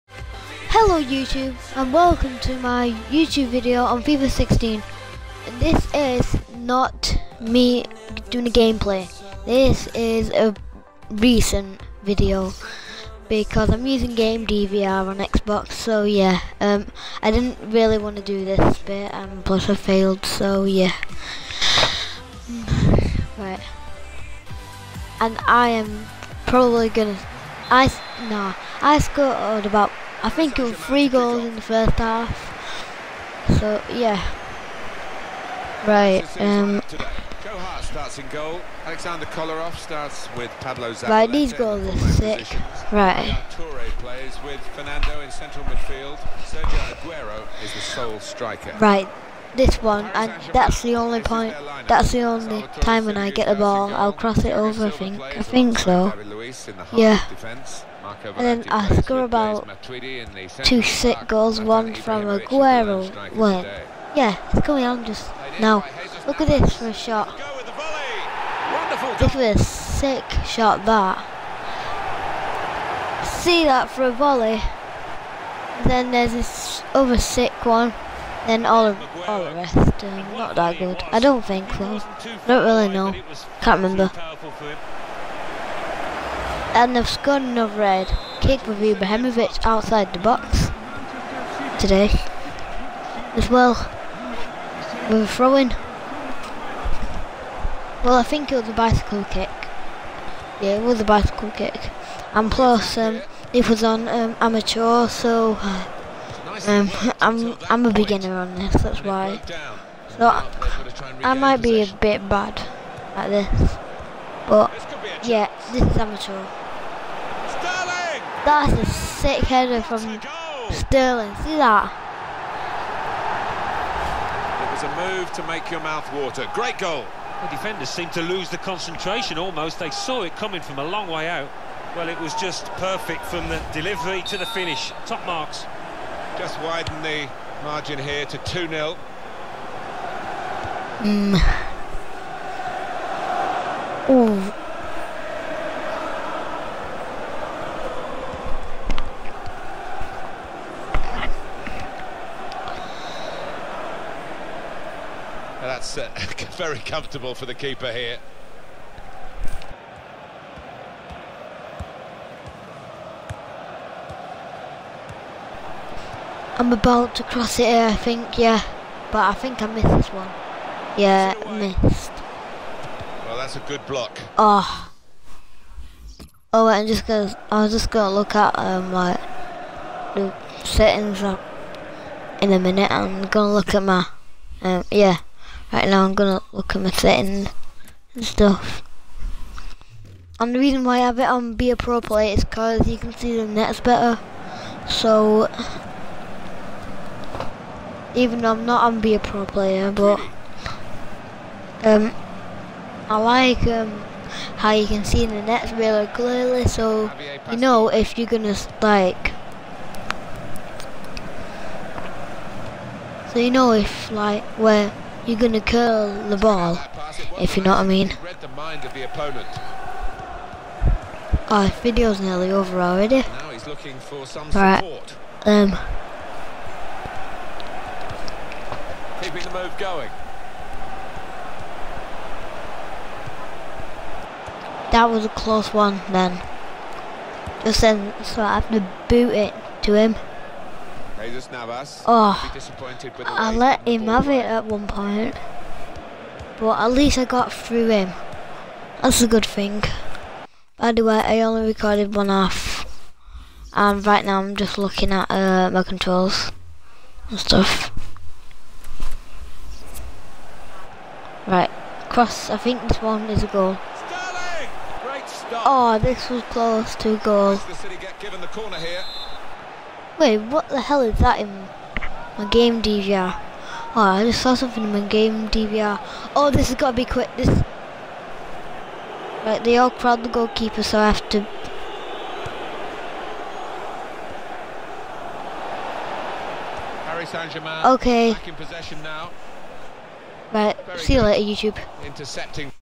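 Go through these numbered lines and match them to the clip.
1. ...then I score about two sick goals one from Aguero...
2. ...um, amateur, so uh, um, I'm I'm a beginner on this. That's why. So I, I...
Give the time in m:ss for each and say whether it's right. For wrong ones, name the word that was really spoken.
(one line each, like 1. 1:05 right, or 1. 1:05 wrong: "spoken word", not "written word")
1. 0:58 right
2. 1:44 right.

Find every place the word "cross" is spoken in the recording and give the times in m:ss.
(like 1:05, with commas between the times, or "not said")
0:54, 2:47, 4:22.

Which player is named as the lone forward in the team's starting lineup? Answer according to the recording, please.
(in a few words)
Sergio Aguero.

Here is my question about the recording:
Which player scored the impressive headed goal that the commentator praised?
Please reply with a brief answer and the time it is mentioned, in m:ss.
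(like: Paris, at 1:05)
Sterling, at 2:00.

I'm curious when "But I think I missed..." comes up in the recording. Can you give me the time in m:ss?
2:49.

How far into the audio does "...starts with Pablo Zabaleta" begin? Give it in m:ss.
0:39.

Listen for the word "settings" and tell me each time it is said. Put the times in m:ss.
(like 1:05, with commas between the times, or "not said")
3:00, 3:06.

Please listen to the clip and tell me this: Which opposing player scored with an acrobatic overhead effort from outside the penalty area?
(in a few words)
Ibrahimovic.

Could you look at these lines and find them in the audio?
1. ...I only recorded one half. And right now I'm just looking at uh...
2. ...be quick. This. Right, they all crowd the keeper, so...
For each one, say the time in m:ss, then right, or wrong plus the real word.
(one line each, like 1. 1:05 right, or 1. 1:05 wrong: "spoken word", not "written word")
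1. 4:11 right
2. 4:36 wrong: "goalkeeper", not "keeper".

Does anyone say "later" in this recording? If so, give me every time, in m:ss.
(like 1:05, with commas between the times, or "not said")
4:51.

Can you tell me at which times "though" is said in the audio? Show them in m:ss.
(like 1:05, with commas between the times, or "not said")
3:18.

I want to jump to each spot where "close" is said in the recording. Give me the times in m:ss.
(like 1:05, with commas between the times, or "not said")
3:55, 4:26.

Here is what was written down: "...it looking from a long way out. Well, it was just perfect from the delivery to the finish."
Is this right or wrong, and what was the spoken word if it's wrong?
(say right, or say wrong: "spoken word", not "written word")
wrong: "coming", not "looking".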